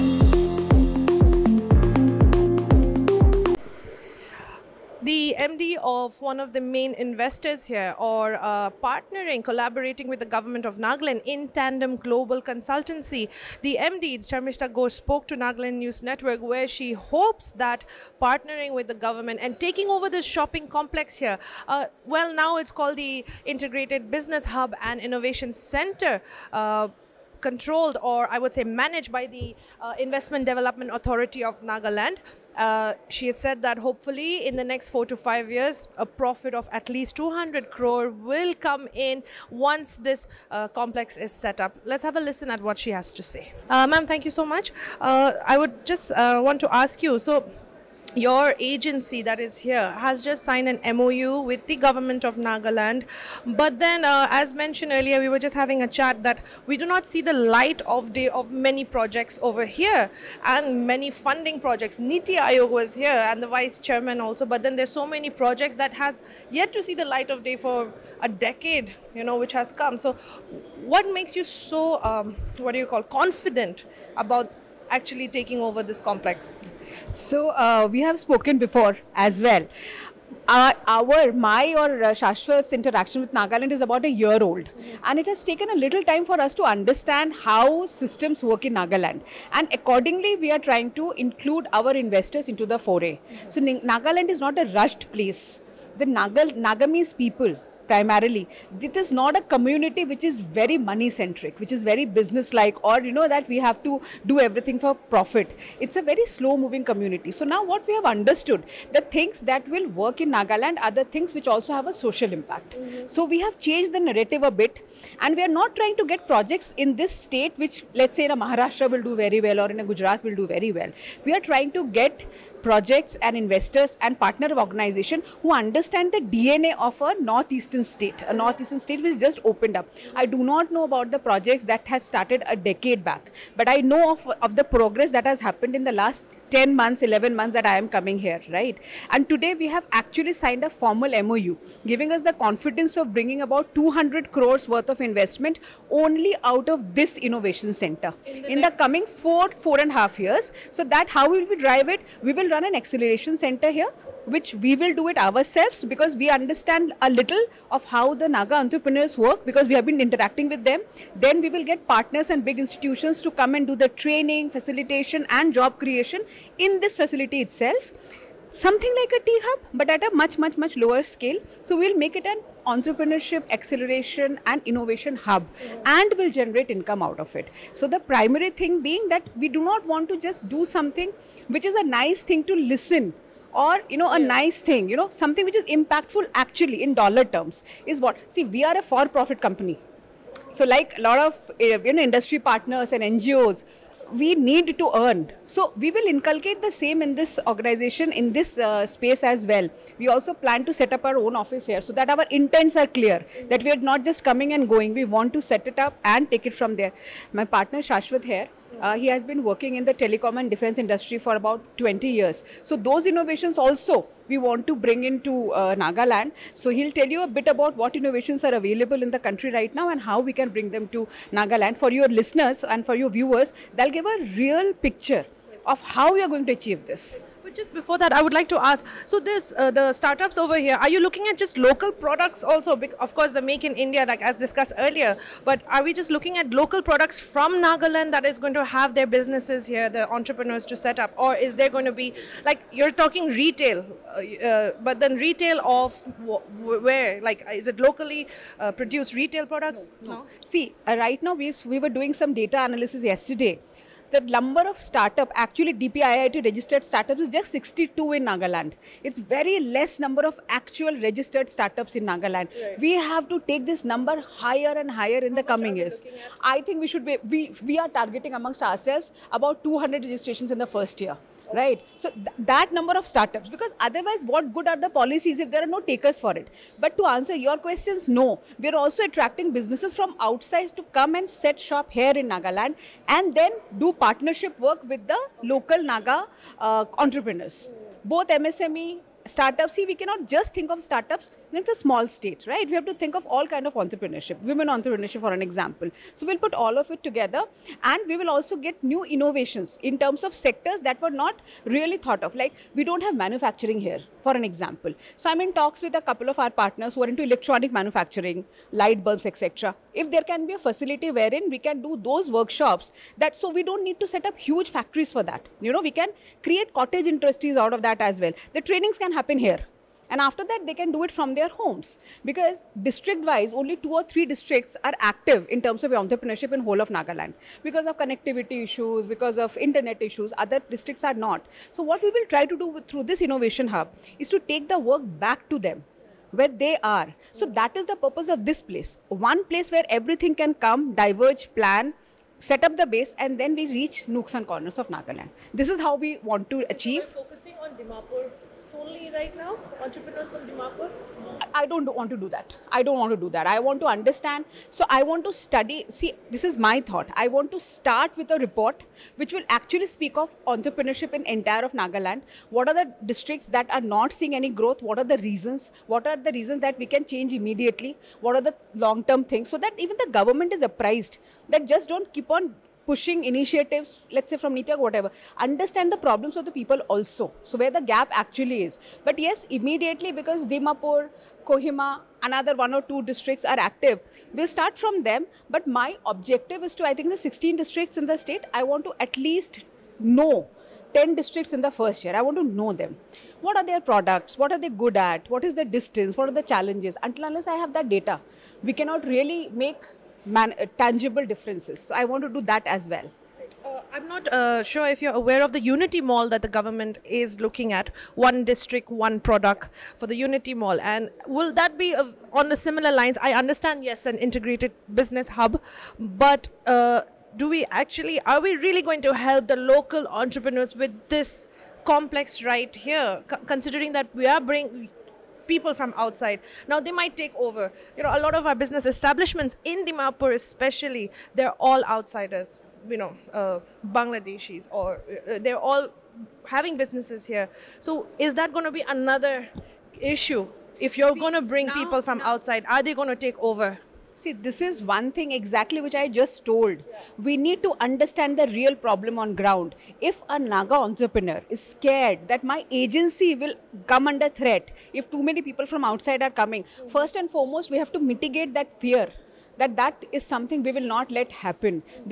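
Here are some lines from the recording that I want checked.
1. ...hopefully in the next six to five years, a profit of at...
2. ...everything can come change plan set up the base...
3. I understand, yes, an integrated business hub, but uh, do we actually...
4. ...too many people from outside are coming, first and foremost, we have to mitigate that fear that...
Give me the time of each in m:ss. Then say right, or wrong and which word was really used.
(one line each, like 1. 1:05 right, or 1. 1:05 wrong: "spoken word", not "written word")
1. 0:33 wrong: "four", not "six"
2. 5:39 wrong: "diverge", not "change"
3. 6:53 right
4. 7:35 right.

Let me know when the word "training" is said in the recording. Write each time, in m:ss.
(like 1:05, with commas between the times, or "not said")
2:43, 5:18.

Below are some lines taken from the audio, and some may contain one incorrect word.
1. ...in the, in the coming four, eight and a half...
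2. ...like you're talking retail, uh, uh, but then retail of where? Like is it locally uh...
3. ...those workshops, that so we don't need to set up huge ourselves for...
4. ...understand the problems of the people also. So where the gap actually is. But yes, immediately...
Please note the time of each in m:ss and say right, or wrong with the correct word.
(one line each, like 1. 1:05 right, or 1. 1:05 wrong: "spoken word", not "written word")
1. 2:28 wrong: "four", not "eight"
2. 4:02 right
3. 5:12 wrong: "factories", not "ourselves"
4. 6:15 right.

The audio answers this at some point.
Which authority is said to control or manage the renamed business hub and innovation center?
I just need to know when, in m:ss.
0:29.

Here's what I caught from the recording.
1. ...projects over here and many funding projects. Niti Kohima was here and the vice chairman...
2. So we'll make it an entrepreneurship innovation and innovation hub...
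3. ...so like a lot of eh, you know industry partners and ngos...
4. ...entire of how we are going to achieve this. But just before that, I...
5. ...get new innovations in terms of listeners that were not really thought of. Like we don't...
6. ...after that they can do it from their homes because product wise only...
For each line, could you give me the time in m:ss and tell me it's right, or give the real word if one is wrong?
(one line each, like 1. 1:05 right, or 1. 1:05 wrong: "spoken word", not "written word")
1. 0:58 wrong: "Aayog", not "Kohima"
2. 2:51 wrong: "acceleration", not "innovation"
3. 3:10 right
4. 3:44 wrong: "picture", not "entire"
5. 4:58 wrong: "sectors", not "listeners"
6. 5:20 wrong: "district", not "product".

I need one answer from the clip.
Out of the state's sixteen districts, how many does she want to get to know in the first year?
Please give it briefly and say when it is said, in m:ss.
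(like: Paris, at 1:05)
10, at 6:30.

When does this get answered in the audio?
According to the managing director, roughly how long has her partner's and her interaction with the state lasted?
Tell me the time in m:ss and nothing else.
1:23.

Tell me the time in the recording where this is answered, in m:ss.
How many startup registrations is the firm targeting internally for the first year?
4:29.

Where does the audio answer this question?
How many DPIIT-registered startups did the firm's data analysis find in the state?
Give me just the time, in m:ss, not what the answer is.
4:17.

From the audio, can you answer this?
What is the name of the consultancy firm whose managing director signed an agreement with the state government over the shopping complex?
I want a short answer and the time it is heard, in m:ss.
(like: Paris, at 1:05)
Tandem Global Consultancy, at 0:11.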